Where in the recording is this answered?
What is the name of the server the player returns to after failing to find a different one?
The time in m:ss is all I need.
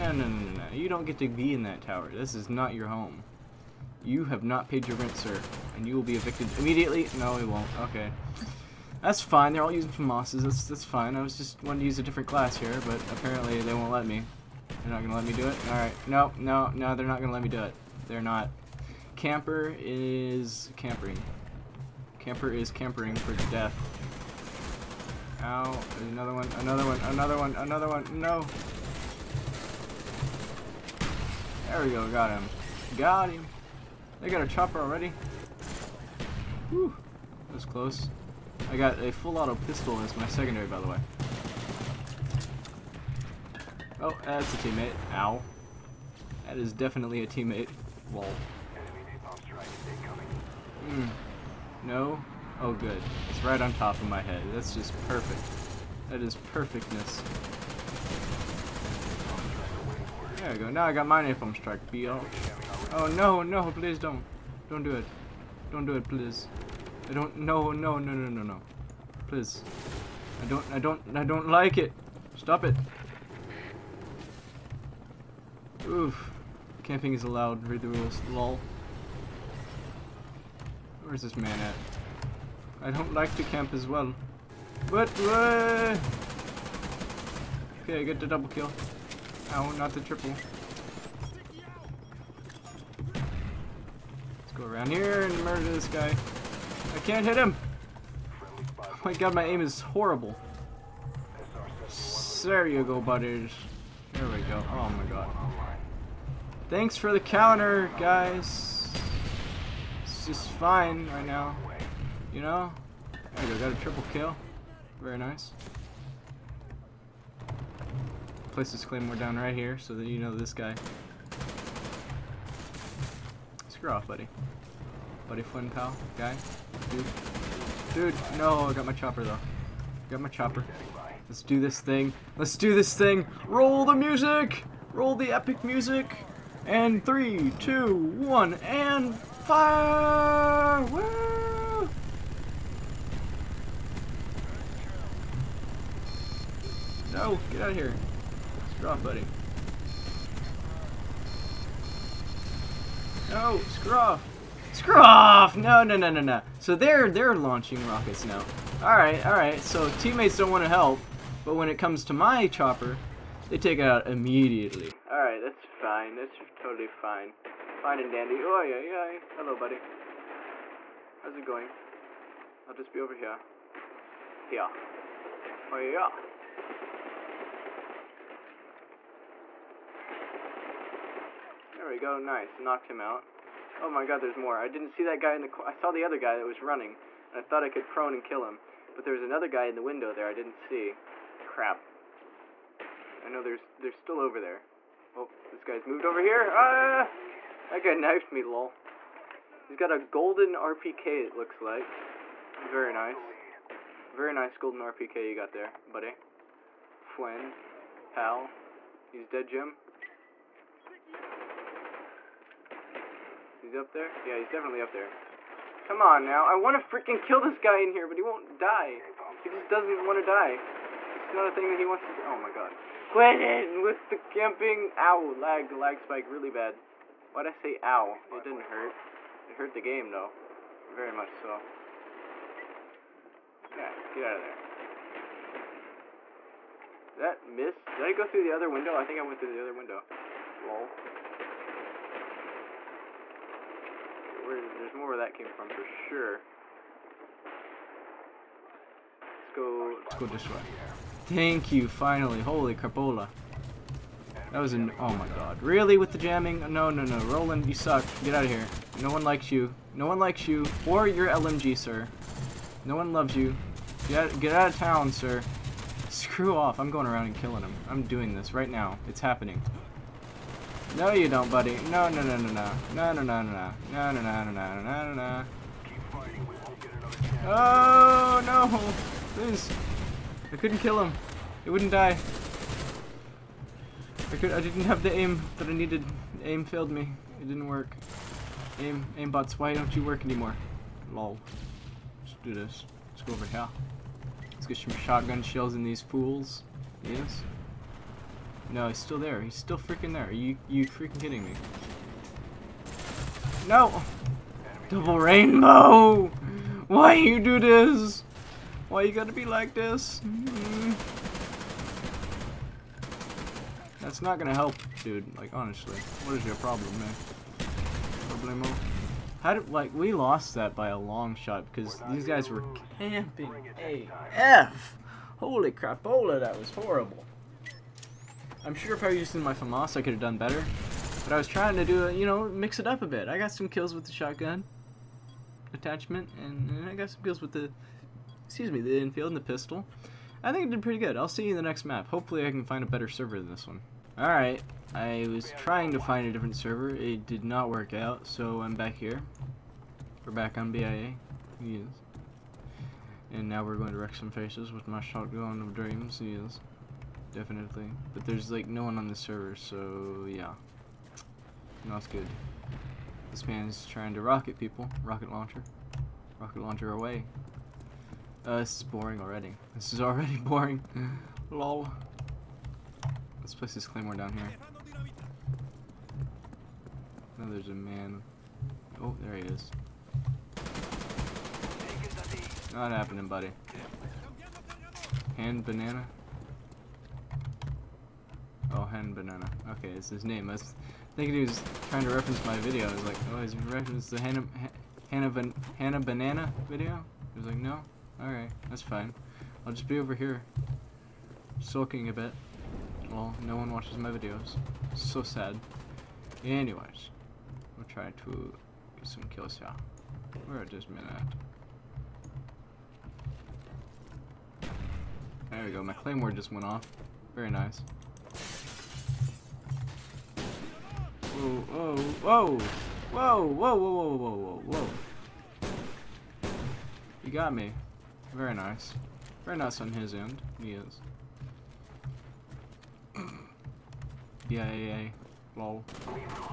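5:50.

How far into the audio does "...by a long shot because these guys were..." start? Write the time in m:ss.
5:20.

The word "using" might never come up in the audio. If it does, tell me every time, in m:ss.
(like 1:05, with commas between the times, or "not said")
0:09, 5:29.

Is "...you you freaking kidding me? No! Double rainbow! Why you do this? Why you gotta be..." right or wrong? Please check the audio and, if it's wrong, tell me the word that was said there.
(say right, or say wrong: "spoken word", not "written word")
right.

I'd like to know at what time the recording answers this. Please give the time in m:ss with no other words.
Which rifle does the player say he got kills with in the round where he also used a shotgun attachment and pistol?
5:38.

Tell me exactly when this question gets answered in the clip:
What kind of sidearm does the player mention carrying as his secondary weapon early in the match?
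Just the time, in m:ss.
0:39.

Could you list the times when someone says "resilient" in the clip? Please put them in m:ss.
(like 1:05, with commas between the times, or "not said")
not said.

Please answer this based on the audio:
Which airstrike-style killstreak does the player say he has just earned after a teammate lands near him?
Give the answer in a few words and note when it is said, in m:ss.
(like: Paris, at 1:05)
Napalm strike, at 1:01.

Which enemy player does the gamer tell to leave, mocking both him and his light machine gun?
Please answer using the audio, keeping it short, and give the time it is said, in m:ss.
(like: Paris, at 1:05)
Roland, at 4:17.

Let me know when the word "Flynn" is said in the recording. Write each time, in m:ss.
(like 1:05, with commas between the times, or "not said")
2:05, 3:27.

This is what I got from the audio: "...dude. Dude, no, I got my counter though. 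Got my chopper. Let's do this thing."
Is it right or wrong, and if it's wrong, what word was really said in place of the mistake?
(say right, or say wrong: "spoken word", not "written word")
wrong: "chopper", not "counter".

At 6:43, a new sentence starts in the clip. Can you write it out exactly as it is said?
Well, no one watches my videos.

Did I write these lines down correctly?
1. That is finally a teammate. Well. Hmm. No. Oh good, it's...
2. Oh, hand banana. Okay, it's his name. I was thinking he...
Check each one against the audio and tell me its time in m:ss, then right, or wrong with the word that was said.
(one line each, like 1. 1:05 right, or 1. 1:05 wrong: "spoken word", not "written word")
1. 0:46 wrong: "definitely", not "finally"
2. 6:28 right.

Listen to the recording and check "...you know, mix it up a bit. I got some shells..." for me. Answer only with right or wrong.
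wrong.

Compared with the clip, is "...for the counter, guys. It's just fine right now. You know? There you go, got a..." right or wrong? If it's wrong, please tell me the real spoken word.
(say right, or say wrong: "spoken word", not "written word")
right.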